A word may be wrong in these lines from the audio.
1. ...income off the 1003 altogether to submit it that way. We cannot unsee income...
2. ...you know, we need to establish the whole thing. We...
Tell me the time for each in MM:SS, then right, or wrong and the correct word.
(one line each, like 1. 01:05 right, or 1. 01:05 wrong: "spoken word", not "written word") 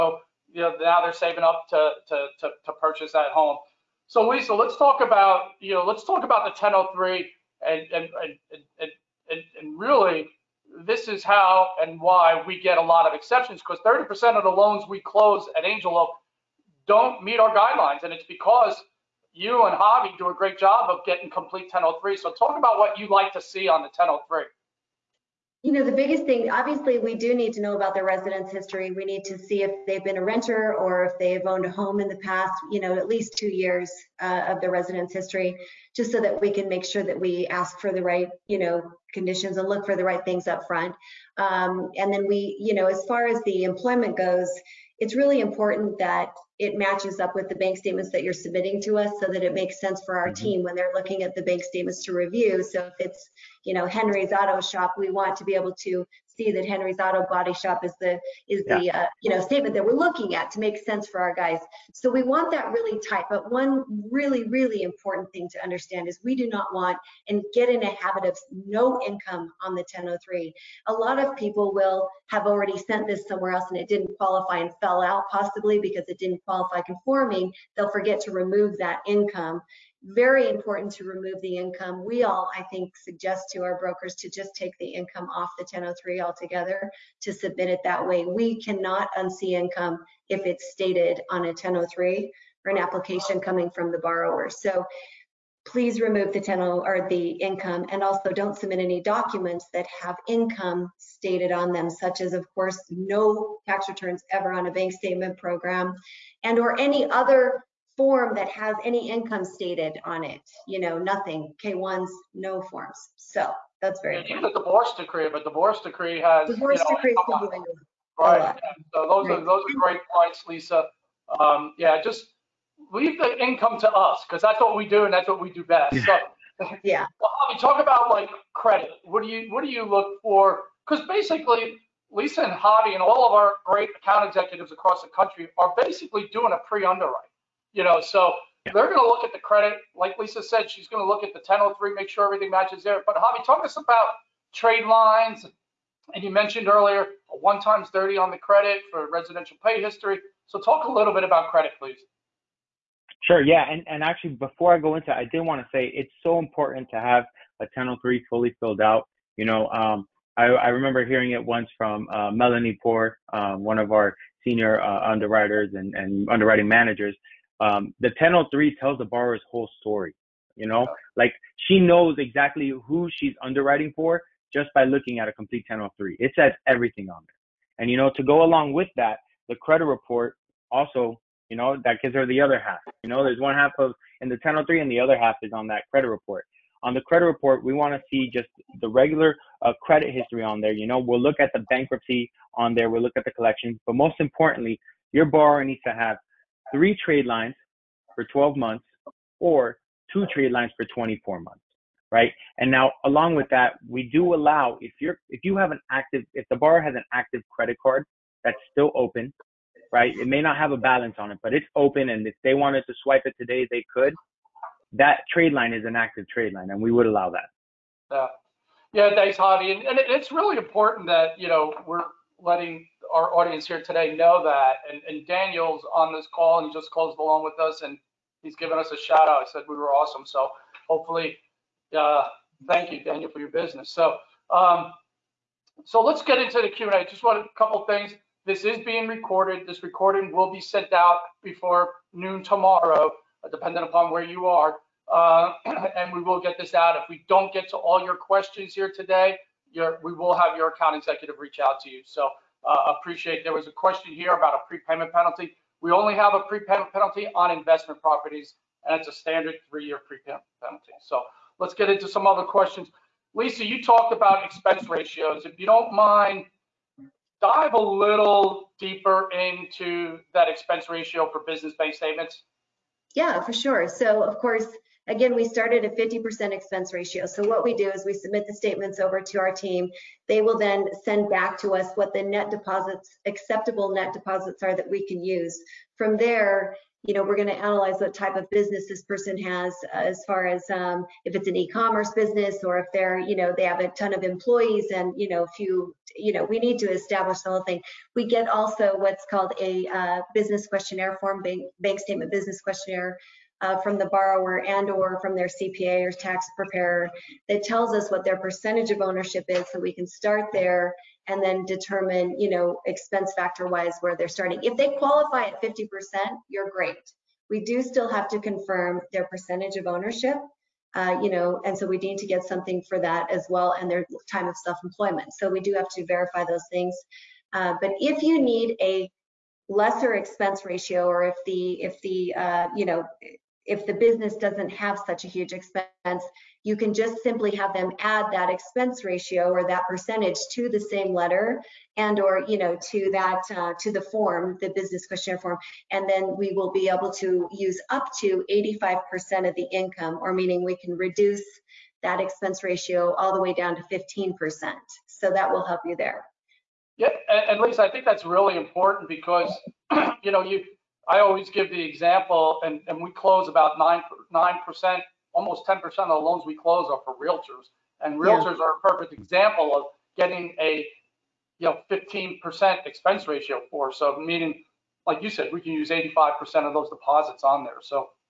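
1. 01:24 right
2. 04:56 right.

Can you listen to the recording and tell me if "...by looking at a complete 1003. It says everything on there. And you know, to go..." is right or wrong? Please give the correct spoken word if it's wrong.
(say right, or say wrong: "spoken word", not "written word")
right.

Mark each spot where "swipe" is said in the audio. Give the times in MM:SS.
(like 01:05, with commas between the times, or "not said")
03:33.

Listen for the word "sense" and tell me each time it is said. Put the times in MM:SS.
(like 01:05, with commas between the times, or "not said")
00:49, 01:00.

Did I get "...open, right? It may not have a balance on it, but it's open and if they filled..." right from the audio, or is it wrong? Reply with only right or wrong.
wrong.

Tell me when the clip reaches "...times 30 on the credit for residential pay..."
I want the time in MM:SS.
02:27.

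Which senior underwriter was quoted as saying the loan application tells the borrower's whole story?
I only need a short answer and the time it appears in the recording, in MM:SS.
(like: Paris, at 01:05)
Melanie Poor, at 02:42.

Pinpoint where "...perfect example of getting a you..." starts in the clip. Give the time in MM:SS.
06:08.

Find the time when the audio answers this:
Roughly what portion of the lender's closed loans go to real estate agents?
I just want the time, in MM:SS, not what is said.
06:05.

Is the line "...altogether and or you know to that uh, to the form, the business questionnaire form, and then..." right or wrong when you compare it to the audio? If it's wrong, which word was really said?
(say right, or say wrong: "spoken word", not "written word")
wrong: "letter", not "altogether".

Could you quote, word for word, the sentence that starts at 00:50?
team when they're looking at the bank statements to review.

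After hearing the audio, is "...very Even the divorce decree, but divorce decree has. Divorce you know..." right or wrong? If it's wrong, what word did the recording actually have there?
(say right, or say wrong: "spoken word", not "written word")
right.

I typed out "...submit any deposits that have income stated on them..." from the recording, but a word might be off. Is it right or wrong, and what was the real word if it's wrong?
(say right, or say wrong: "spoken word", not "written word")
wrong: "documents", not "deposits".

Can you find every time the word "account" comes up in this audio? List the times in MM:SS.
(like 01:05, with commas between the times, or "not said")
02:13, 04:10.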